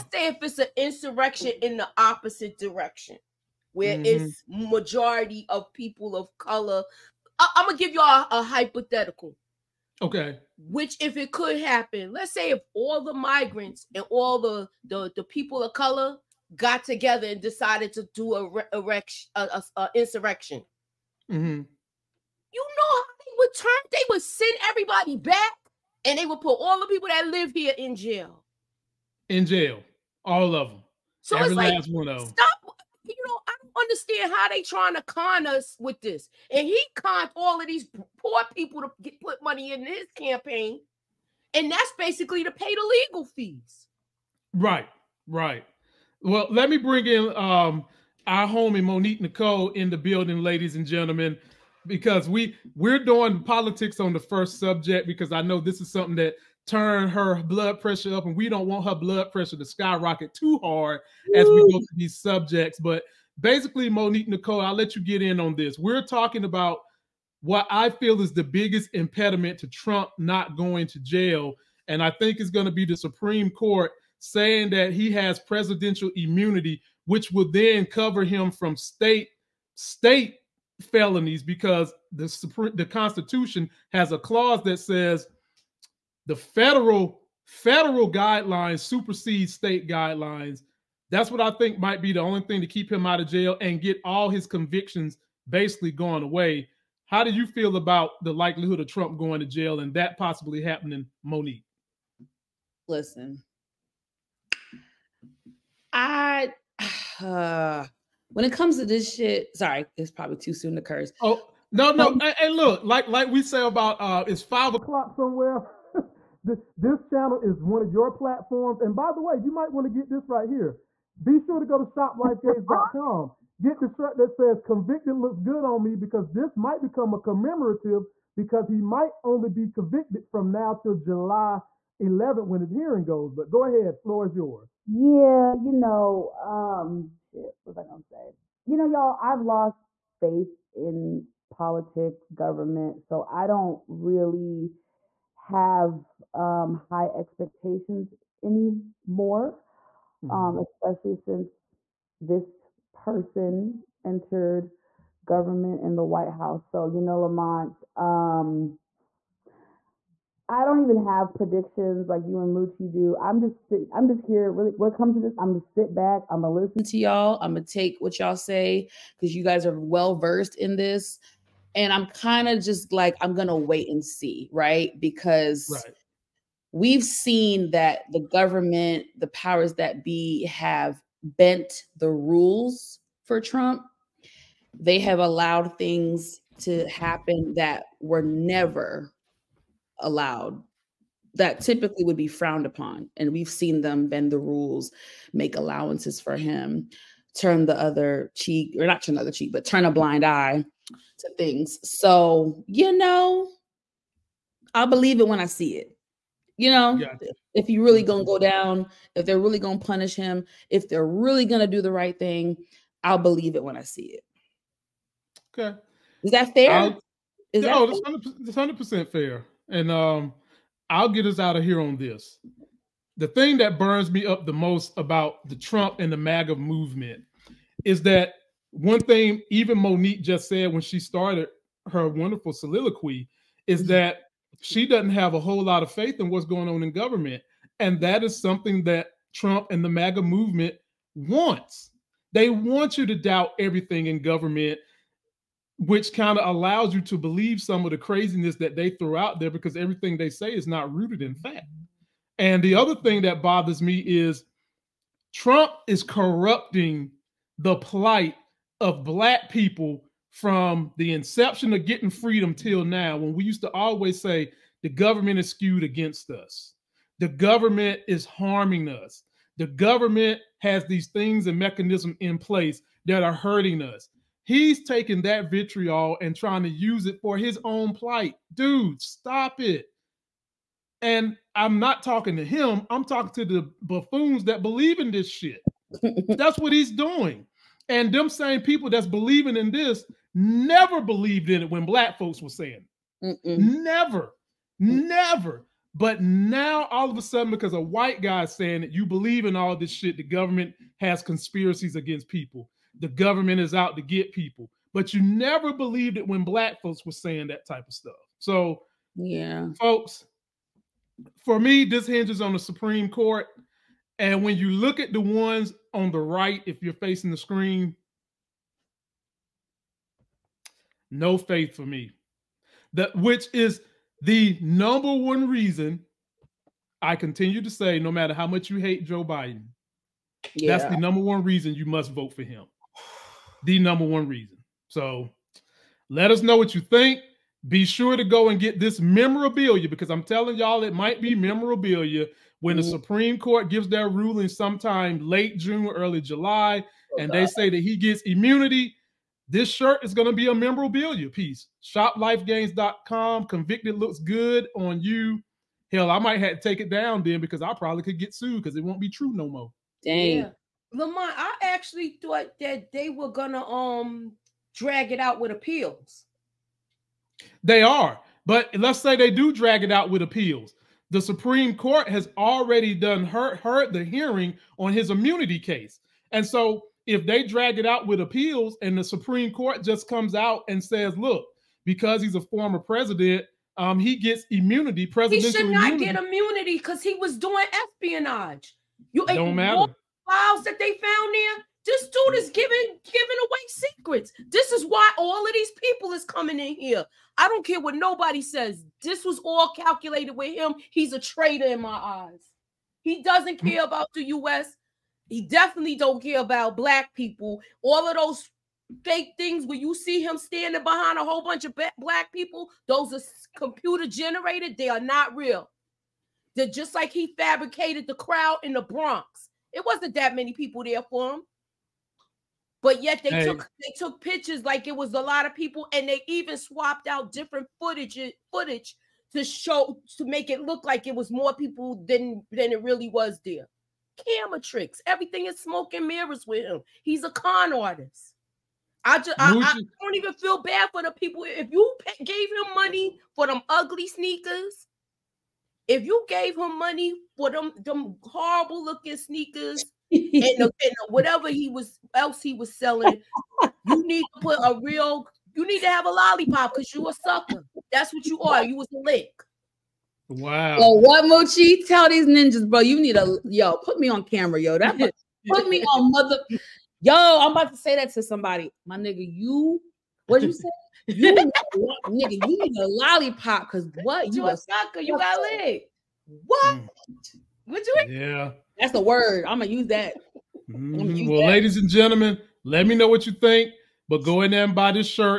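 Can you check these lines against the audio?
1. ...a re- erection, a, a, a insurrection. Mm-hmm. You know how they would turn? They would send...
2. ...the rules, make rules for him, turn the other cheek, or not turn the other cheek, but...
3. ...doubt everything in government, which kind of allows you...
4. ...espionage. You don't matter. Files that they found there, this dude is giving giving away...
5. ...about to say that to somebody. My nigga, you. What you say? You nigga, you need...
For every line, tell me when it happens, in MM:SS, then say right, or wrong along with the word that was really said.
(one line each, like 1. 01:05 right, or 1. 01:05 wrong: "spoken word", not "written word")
1. 00:18 right
2. 03:14 wrong: "allowances", not "rules"
3. 04:03 right
4. 06:27 right
5. 07:47 right.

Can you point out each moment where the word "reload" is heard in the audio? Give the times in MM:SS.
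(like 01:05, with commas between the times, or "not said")
not said.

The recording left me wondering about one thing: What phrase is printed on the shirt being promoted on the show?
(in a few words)
Convicted looks good on me.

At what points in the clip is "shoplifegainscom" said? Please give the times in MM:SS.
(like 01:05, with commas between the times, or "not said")
02:01, 05:51.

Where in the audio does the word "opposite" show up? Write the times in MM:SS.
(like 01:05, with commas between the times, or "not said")
00:01.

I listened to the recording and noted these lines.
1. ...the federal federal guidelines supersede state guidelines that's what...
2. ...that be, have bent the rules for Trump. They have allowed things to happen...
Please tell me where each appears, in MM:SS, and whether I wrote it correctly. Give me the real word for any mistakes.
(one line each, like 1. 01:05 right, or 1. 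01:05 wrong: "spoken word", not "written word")
1. 01:26 right
2. 02:59 right.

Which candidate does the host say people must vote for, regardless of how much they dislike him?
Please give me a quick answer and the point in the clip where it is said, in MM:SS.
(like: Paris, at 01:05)
Joe Biden, at 05:29.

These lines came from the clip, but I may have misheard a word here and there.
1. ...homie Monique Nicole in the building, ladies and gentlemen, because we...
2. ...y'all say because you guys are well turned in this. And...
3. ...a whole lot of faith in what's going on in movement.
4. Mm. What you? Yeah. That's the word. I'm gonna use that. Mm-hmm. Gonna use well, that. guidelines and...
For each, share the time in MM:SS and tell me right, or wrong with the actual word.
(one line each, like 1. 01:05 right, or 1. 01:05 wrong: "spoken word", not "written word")
1. 00:48 right
2. 02:48 wrong: "versed", not "turned"
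3. 03:55 wrong: "government", not "movement"
4. 07:56 wrong: "ladies", not "guidelines".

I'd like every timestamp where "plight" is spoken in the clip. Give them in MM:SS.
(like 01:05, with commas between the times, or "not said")
04:17, 04:37.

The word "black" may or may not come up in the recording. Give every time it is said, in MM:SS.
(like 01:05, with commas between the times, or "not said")
04:19, 04:51, 05:06, 06:46, 06:51.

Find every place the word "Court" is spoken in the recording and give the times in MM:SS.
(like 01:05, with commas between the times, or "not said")
01:13, 05:13, 05:43, 06:11, 06:19.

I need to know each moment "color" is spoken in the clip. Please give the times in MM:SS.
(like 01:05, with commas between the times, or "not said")
00:06, 00:15.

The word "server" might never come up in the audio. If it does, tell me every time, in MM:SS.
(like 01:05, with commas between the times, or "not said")
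not said.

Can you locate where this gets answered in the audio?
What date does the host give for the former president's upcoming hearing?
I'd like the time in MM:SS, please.
02:10.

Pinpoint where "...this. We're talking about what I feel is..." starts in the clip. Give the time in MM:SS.
01:05.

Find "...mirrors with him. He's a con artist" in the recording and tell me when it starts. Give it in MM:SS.
07:16.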